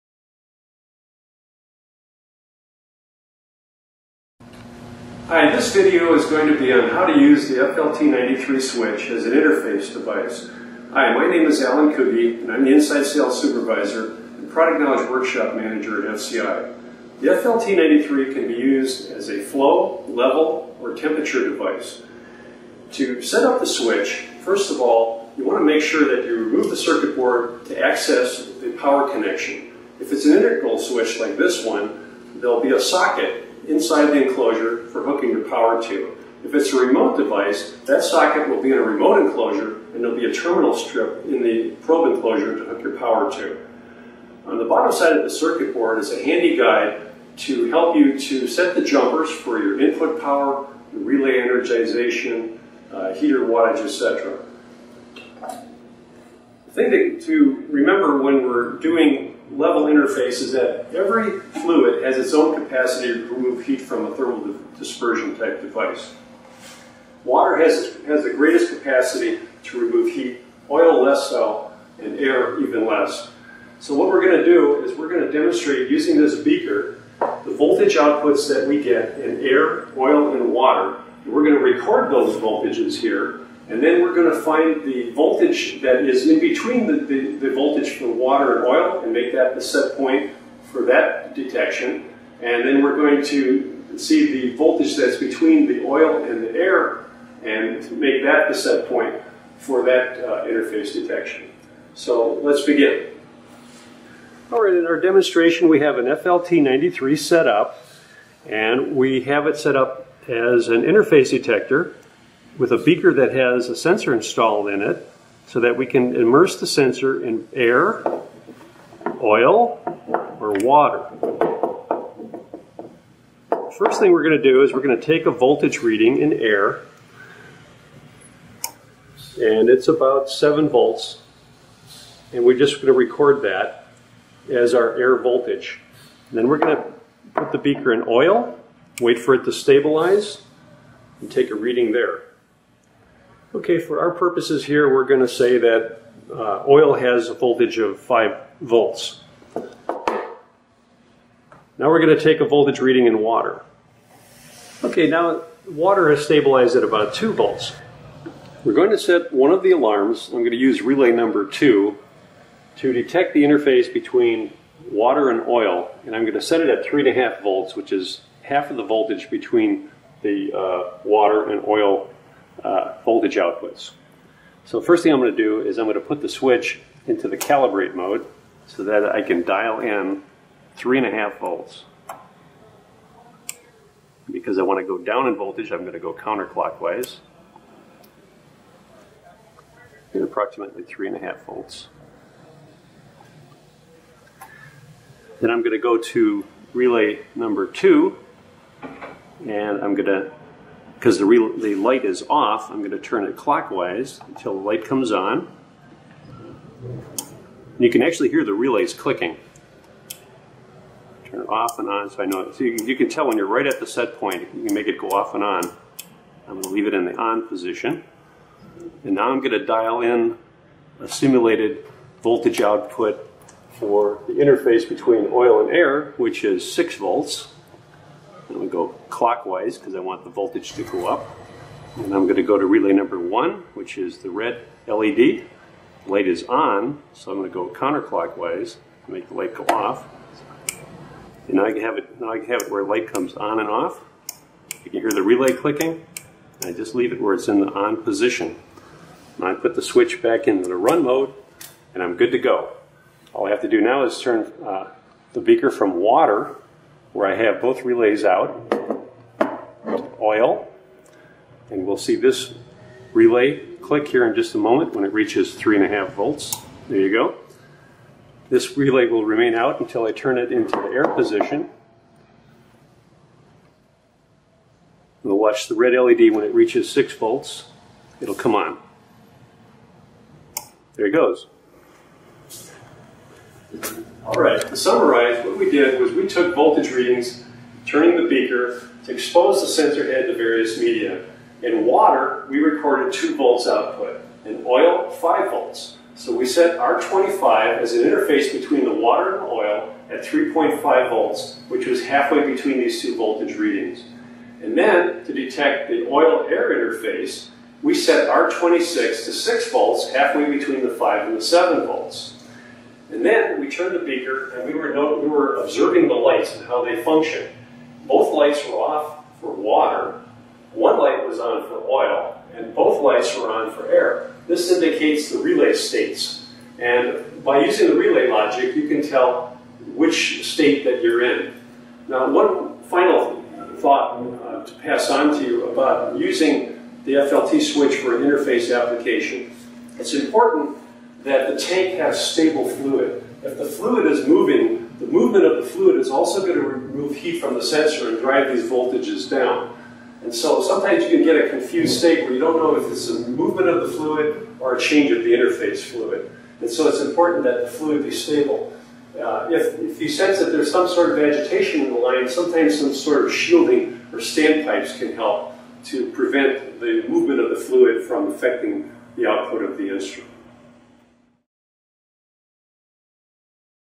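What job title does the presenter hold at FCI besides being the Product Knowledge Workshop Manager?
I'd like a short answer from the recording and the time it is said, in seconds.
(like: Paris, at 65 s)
Inside Sales Supervisor, at 12 s.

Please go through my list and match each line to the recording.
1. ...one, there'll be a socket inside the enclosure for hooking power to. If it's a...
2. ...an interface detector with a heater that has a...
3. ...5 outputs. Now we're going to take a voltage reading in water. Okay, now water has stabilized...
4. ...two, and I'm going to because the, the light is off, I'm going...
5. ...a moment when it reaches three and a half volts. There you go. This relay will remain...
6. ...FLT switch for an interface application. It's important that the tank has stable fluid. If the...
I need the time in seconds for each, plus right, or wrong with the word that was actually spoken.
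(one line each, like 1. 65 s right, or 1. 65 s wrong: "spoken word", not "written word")
1. 31 s right
2. 110 s wrong: "beaker", not "heater"
3. 147 s wrong: "volts", not "outputs"
4. 197 s right
5. 264 s right
6. 337 s right.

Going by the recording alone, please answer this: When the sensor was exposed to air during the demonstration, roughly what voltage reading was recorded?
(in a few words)
7 volts.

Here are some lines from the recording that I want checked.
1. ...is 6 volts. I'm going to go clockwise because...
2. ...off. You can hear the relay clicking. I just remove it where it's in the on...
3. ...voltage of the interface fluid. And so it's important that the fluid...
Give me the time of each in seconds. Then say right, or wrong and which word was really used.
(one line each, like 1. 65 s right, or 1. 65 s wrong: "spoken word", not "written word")
1. 226 s right
2. 243 s wrong: "leave", not "remove"
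3. 354 s wrong: "change", not "voltage".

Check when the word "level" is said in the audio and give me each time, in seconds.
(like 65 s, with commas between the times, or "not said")
20 s, 59 s.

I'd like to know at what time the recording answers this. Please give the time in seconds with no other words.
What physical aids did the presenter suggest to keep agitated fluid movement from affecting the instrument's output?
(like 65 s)
363 s.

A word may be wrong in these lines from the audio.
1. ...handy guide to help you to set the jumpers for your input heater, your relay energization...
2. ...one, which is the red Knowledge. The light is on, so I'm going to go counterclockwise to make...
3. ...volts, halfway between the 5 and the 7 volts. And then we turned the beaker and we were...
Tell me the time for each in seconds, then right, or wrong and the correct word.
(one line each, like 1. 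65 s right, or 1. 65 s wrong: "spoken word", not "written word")
1. 46 s wrong: "power", not "heater"
2. 233 s wrong: "LED", not "Knowledge"
3. 309 s right.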